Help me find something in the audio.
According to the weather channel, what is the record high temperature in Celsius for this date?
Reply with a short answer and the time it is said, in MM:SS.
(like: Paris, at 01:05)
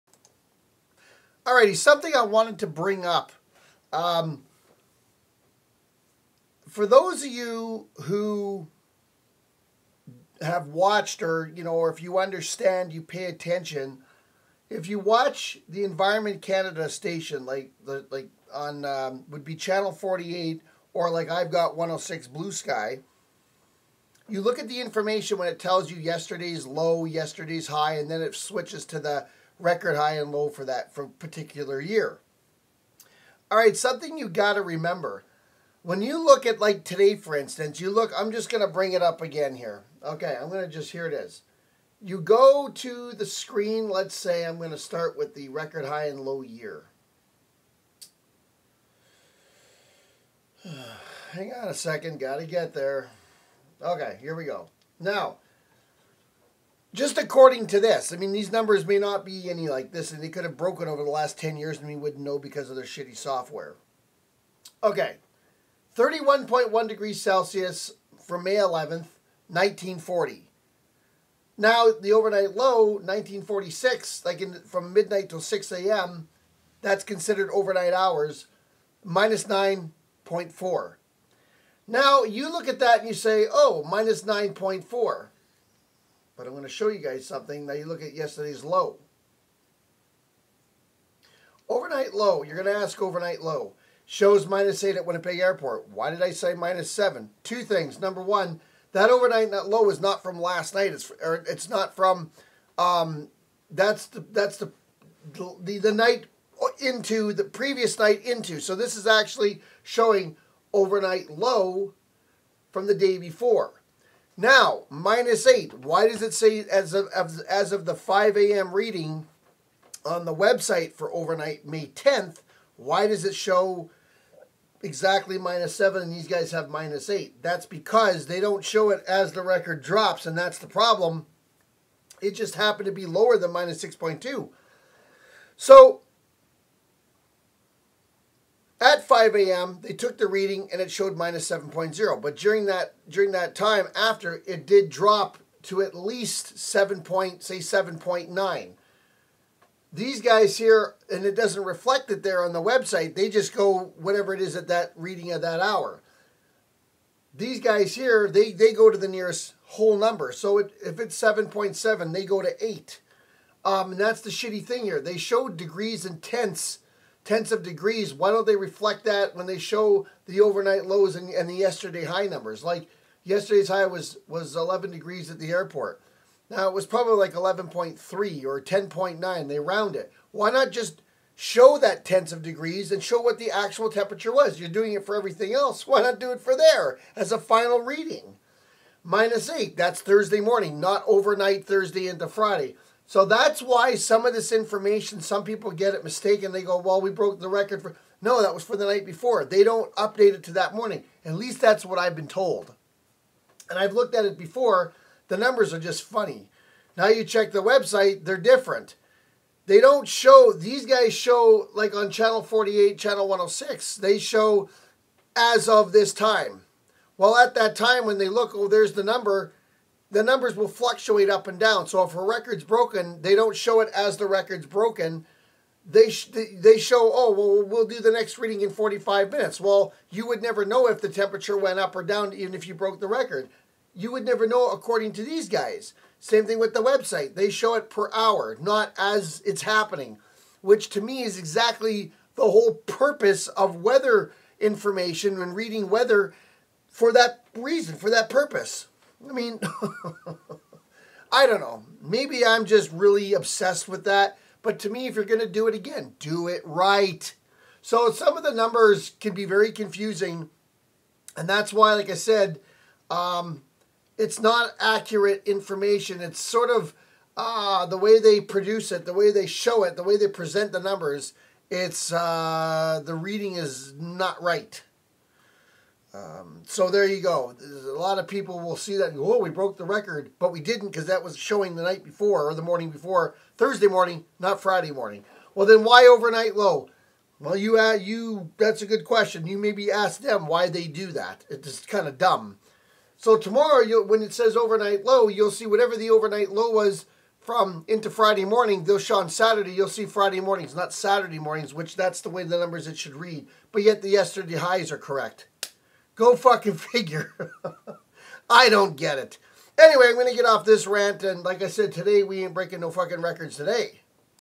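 31.1, at 01:05.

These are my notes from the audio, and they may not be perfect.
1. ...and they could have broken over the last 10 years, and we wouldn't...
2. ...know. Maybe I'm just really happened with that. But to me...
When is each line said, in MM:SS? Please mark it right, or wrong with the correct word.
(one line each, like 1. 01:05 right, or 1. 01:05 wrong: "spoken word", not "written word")
1. 01:00 right
2. 04:11 wrong: "obsessed", not "happened".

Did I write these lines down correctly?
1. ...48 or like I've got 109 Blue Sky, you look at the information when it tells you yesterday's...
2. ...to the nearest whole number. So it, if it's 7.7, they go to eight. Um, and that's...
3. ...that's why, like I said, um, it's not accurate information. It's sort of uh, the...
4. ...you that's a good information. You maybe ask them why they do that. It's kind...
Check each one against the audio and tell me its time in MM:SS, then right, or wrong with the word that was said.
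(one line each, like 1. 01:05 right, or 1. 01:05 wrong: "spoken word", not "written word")
1. 00:19 wrong: "106", not "109"
2. 02:38 right
3. 04:21 right
4. 04:47 wrong: "question", not "information".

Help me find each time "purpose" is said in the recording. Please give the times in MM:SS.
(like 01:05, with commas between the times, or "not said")
04:02, 04:08.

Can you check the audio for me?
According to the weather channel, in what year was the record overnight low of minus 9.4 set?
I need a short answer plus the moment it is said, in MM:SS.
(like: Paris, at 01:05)
1946, at 01:12.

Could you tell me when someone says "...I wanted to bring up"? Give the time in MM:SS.
00:02.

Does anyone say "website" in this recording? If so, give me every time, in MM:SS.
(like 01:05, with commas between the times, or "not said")
02:00, 02:32, 03:27, 03:56.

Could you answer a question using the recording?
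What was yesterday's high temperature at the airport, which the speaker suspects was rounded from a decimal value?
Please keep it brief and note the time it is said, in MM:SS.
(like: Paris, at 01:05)
11 degrees, at 02:54.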